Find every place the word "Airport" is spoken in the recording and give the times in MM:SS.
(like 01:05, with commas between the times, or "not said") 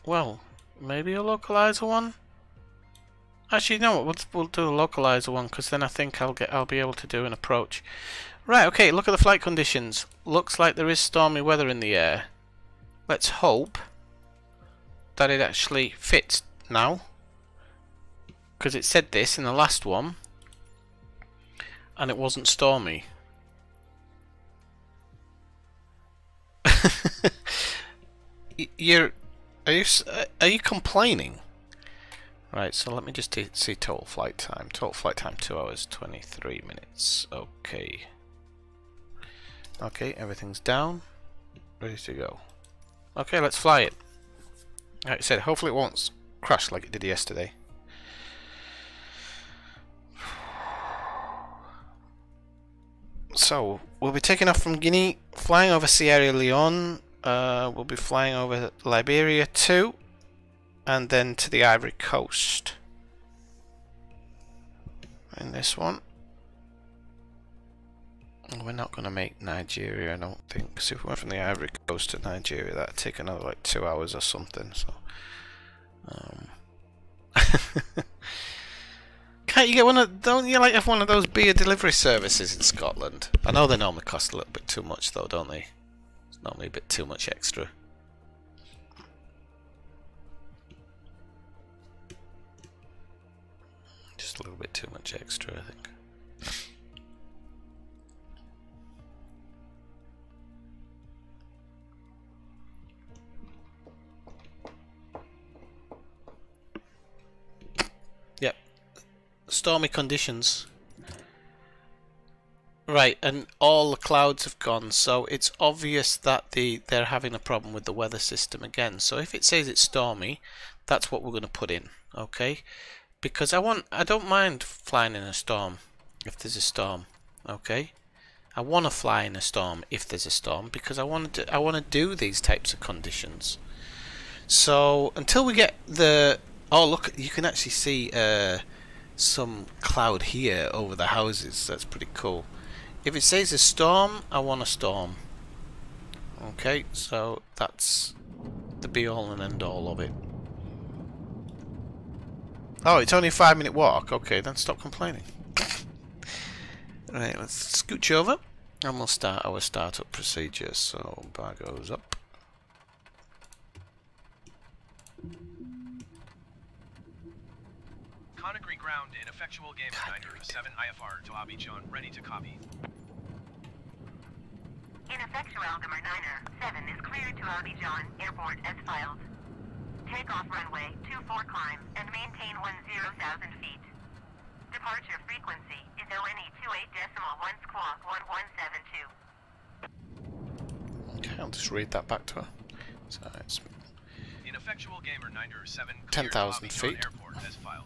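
02:58, 03:17.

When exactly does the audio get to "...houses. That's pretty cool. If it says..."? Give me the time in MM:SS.
02:21.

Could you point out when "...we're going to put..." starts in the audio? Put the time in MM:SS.
02:01.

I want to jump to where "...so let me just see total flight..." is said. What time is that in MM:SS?
00:32.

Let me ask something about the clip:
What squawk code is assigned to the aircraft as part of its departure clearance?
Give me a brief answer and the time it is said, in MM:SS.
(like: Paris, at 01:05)
1172, at 03:08.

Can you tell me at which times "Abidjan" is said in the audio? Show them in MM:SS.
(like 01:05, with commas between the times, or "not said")
02:51, 02:57.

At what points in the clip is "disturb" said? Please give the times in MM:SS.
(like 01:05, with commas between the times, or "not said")
not said.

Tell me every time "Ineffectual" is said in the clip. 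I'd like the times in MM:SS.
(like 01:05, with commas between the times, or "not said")
02:55, 03:14.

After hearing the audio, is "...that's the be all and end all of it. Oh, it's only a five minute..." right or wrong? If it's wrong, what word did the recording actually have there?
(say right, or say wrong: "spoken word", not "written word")
right.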